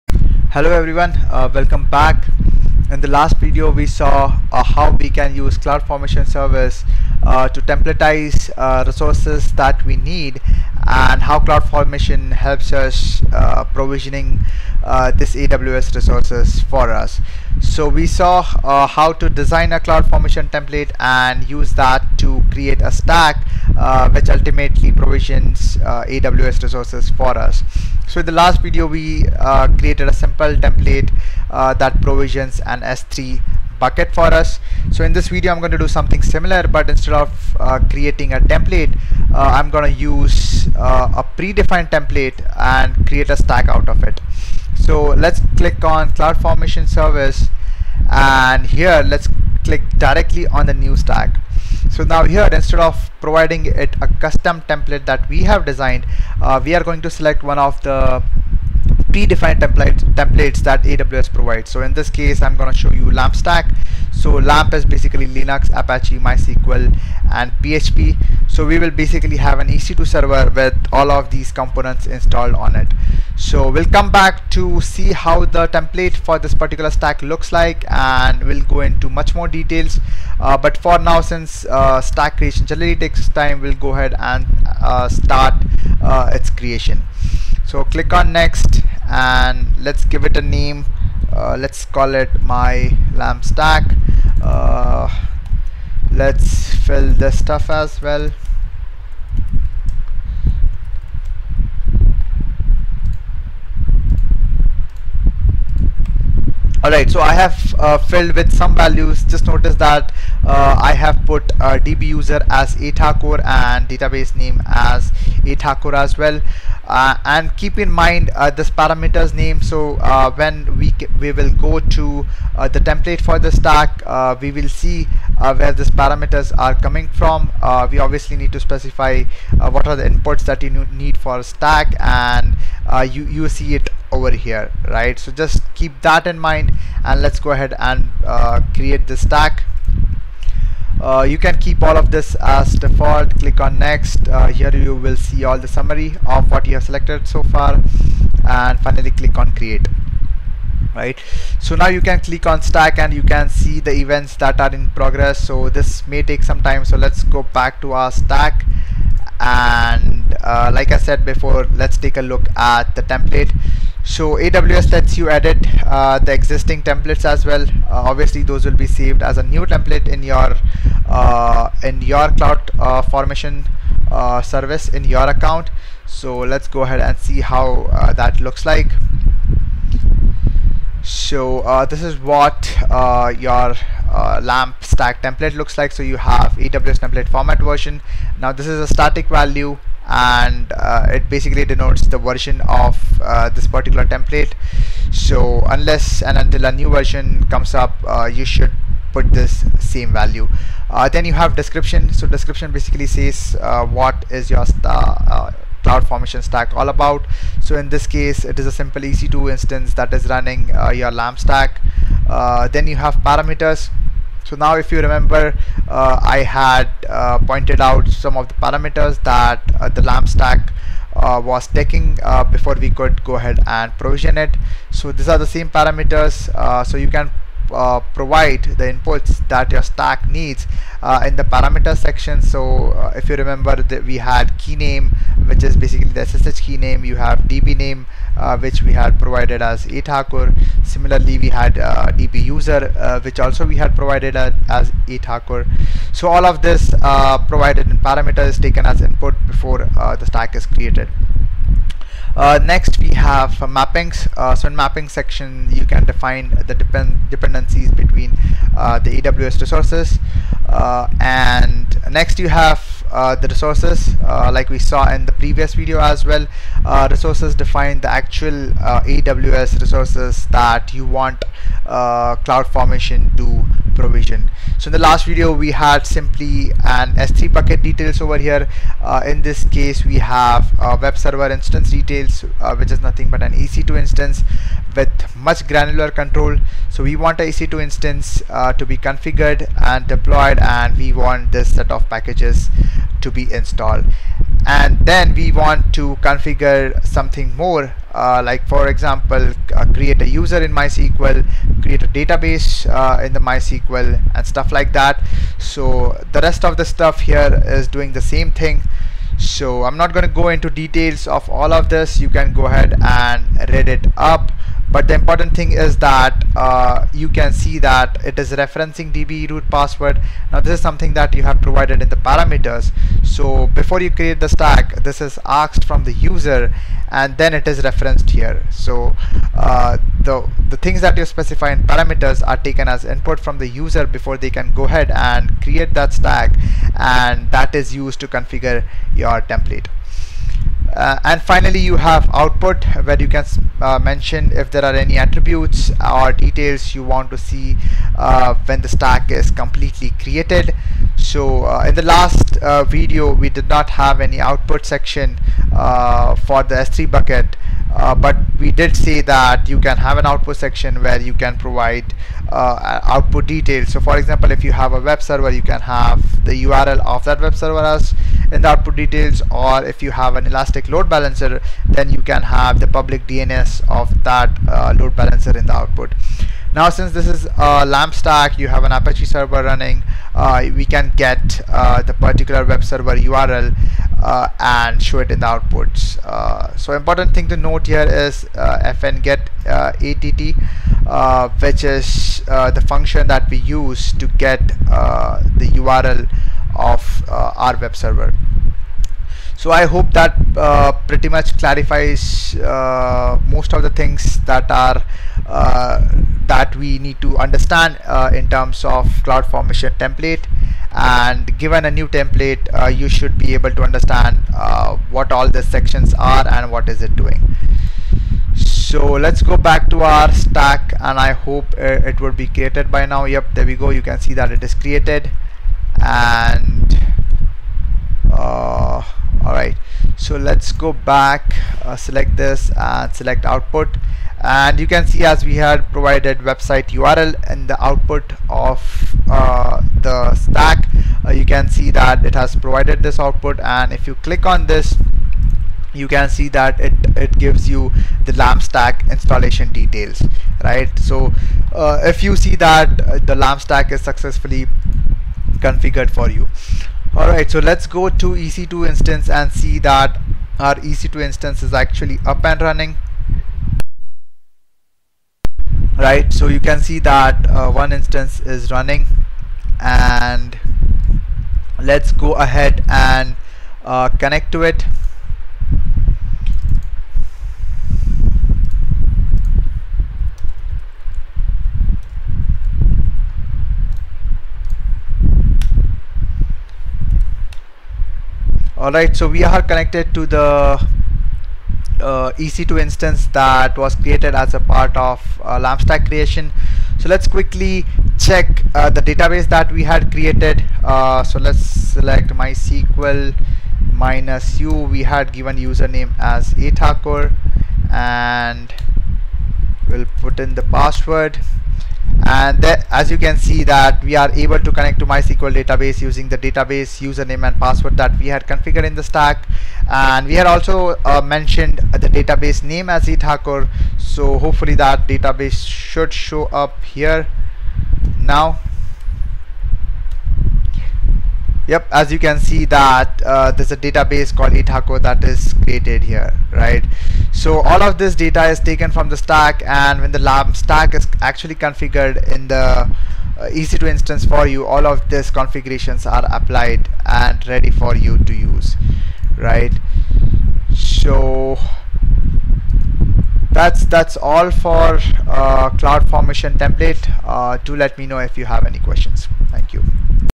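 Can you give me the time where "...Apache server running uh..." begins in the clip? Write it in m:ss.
6:18.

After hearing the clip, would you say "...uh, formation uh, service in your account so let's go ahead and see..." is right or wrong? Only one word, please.
right.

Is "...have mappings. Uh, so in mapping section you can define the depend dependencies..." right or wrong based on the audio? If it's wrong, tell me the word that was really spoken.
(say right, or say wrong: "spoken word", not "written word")
right.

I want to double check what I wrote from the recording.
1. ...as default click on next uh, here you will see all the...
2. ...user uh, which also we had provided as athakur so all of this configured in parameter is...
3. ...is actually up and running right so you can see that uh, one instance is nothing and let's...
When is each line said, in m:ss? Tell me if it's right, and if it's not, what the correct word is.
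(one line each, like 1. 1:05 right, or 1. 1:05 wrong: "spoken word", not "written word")
1. 2:22 right
2. 4:02 wrong: "provided", not "configured"
3. 7:41 wrong: "running", not "nothing".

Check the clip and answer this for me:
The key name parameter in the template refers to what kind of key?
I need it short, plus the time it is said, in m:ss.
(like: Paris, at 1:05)
SSH key, at 3:56.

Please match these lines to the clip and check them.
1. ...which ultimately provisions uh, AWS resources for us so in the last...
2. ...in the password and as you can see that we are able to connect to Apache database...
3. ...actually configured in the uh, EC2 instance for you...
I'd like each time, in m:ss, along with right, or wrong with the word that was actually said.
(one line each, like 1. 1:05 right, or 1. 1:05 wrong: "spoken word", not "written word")
1. 0:24 right
2. 8:30 wrong: "MySQL", not "Apache"
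3. 9:01 right.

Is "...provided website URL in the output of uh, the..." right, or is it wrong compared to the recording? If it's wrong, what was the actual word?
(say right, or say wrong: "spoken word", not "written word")
right.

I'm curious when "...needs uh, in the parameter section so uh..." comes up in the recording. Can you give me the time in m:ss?
3:50.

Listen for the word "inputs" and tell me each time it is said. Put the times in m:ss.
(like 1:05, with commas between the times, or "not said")
2:10, 3:48, 4:09, 5:33.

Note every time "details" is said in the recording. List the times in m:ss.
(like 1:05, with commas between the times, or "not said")
1:19, 4:37, 4:41, 5:10, 5:46, 6:03, 6:08, 7:29.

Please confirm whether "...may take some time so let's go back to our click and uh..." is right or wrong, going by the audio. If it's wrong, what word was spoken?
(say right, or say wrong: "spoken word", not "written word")
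wrong: "stack", not "click".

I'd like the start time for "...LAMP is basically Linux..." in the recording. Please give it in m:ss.
1:04.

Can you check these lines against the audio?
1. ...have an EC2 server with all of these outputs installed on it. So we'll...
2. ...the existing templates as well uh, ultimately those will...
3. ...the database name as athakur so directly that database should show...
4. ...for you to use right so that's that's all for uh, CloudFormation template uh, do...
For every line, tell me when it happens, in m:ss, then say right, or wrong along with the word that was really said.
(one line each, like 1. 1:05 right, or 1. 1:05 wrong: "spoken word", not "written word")
1. 1:09 wrong: "components", not "outputs"
2. 2:46 wrong: "obviously", not "ultimately"
3. 8:41 wrong: "hopefully", not "directly"
4. 9:07 right.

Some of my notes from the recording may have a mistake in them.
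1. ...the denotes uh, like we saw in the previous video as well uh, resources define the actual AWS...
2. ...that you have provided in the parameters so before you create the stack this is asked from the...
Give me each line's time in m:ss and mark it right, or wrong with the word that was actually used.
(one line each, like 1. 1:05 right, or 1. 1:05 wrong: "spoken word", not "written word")
1. 4:23 wrong: "resources", not "denotes"
2. 5:21 right.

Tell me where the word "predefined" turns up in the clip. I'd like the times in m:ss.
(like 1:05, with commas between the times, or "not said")
0:41, 0:59.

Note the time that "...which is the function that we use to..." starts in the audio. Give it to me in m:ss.
6:31.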